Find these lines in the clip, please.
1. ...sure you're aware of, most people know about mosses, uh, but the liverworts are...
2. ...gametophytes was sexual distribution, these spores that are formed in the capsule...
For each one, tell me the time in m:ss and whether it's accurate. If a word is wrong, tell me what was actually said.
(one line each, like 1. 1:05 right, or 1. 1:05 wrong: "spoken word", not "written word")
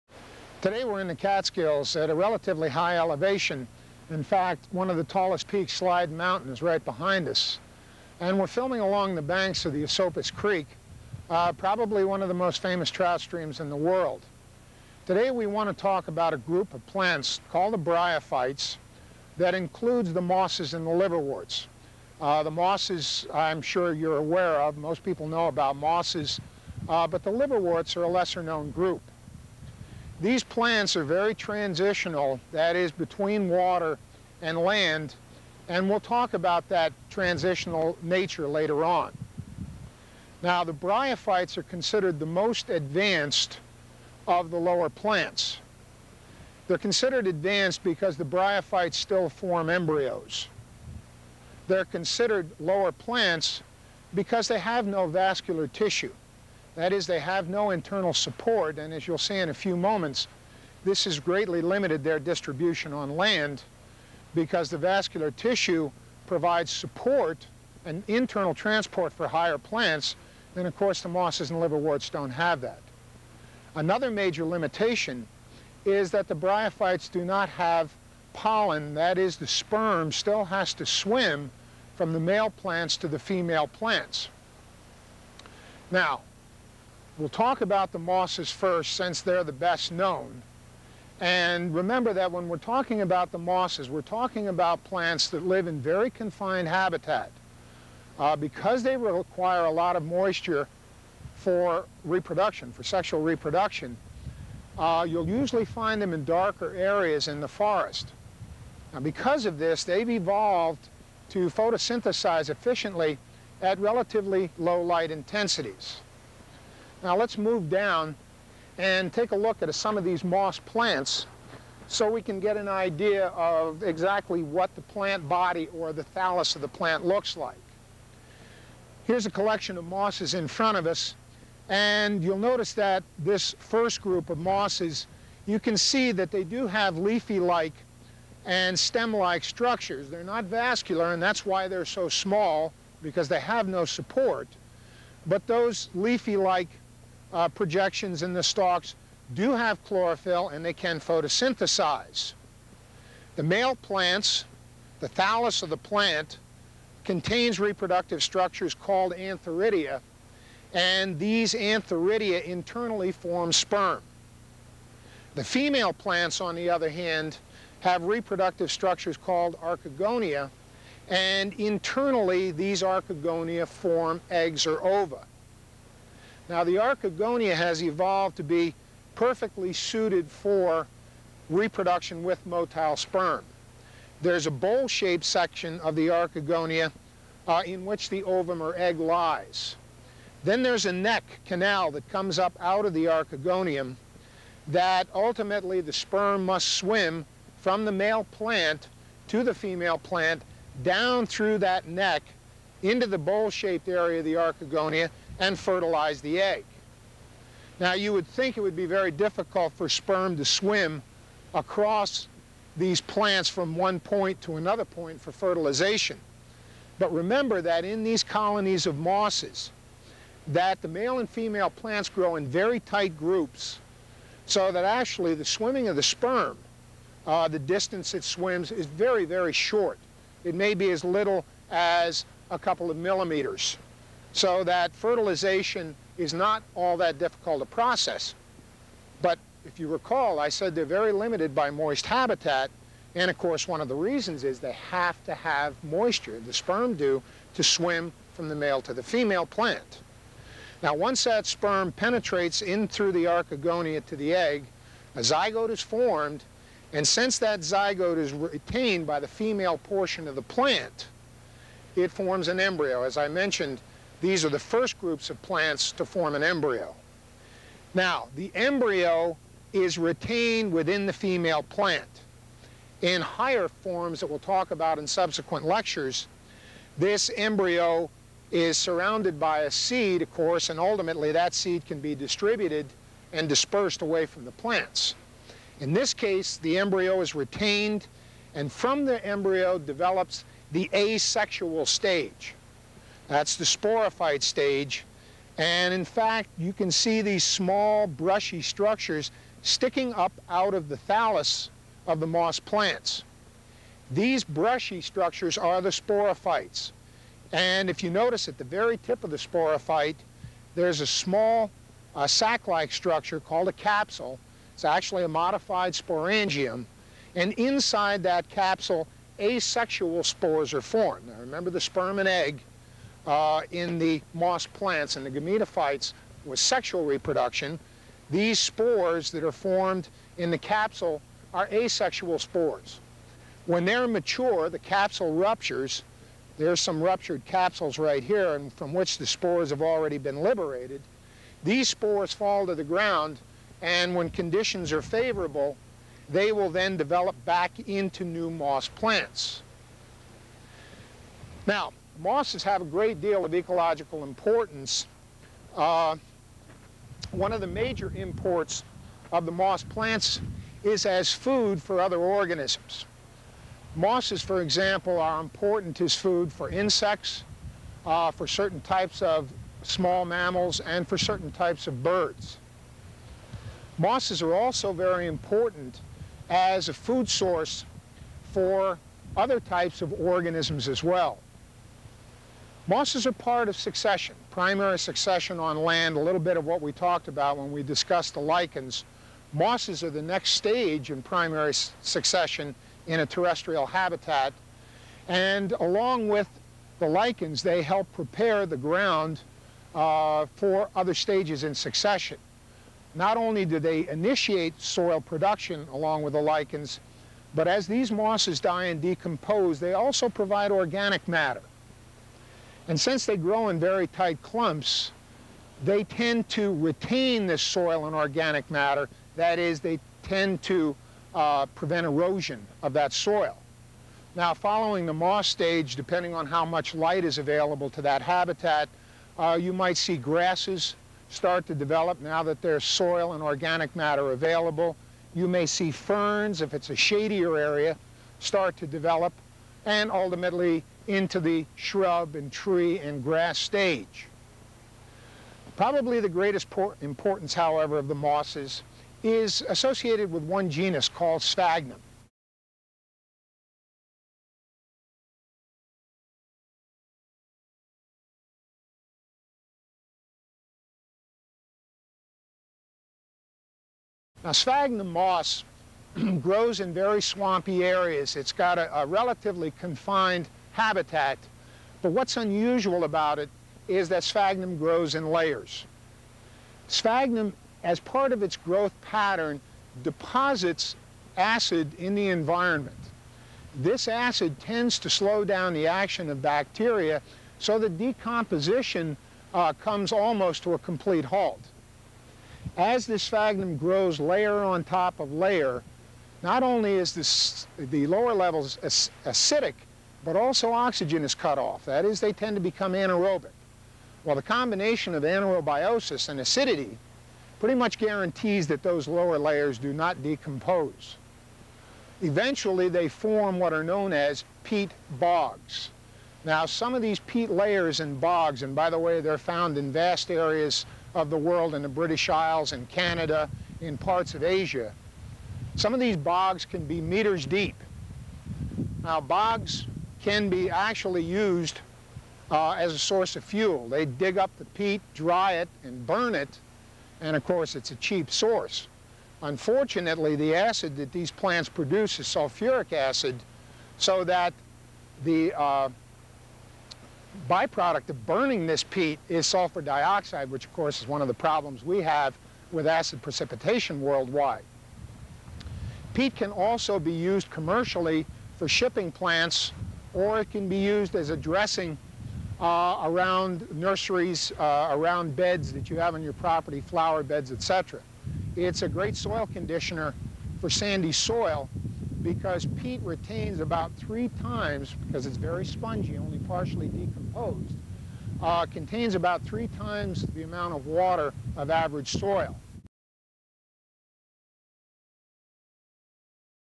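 1. 0:23 right
2. 5:25 wrong: "reproduction", not "distribution".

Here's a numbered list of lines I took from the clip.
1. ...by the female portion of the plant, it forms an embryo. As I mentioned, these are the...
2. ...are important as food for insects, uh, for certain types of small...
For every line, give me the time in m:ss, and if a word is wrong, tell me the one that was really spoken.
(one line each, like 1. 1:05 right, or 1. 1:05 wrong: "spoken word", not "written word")
1. 4:19 right
2. 6:05 right.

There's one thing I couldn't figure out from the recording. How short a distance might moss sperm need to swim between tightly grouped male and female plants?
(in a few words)
a couple of millimeters.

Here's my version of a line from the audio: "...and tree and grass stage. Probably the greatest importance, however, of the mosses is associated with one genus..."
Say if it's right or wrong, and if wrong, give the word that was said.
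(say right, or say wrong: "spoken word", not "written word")
right.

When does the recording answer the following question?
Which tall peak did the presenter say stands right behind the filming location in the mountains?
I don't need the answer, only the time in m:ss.
0:05.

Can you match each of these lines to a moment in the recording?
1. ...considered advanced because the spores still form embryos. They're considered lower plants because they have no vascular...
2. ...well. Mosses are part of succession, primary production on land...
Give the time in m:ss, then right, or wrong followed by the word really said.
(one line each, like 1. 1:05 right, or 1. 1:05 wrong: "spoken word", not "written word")
1. 0:46 wrong: "bryophytes", not "spores"
2. 6:21 wrong: "succession", not "production".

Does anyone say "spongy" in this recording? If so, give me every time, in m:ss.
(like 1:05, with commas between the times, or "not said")
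9:35.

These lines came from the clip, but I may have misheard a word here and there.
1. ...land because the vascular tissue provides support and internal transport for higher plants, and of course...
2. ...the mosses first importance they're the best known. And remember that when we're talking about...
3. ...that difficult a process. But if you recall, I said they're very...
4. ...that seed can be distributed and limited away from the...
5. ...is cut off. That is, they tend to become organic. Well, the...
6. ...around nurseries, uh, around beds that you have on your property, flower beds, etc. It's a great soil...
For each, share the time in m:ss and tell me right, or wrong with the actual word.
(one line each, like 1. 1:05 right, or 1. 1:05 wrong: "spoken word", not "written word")
1. 1:03 right
2. 1:27 wrong: "since", not "importance"
3. 3:56 right
4. 4:41 wrong: "dispersed", not "limited"
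5. 8:21 wrong: "anaerobic", not "organic"
6. 9:23 right.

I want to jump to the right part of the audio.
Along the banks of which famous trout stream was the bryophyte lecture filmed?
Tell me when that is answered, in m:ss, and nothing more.
0:09.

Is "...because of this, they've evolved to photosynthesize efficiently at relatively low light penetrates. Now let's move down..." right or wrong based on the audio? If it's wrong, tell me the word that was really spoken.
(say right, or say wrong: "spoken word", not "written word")
wrong: "intensities", not "penetrates".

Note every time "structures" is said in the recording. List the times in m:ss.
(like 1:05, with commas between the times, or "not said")
2:19, 2:38, 2:48, 4:58, 5:05, 5:12.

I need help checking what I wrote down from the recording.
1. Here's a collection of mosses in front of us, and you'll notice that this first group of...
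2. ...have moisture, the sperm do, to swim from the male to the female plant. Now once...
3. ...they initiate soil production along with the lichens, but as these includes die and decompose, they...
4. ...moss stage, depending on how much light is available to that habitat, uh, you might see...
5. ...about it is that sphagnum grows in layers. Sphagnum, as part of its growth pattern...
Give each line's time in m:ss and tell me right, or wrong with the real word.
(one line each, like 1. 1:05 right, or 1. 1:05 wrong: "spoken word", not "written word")
1. 2:09 right
2. 4:05 right
3. 6:43 wrong: "mosses", not "includes"
4. 7:05 right
5. 7:53 right.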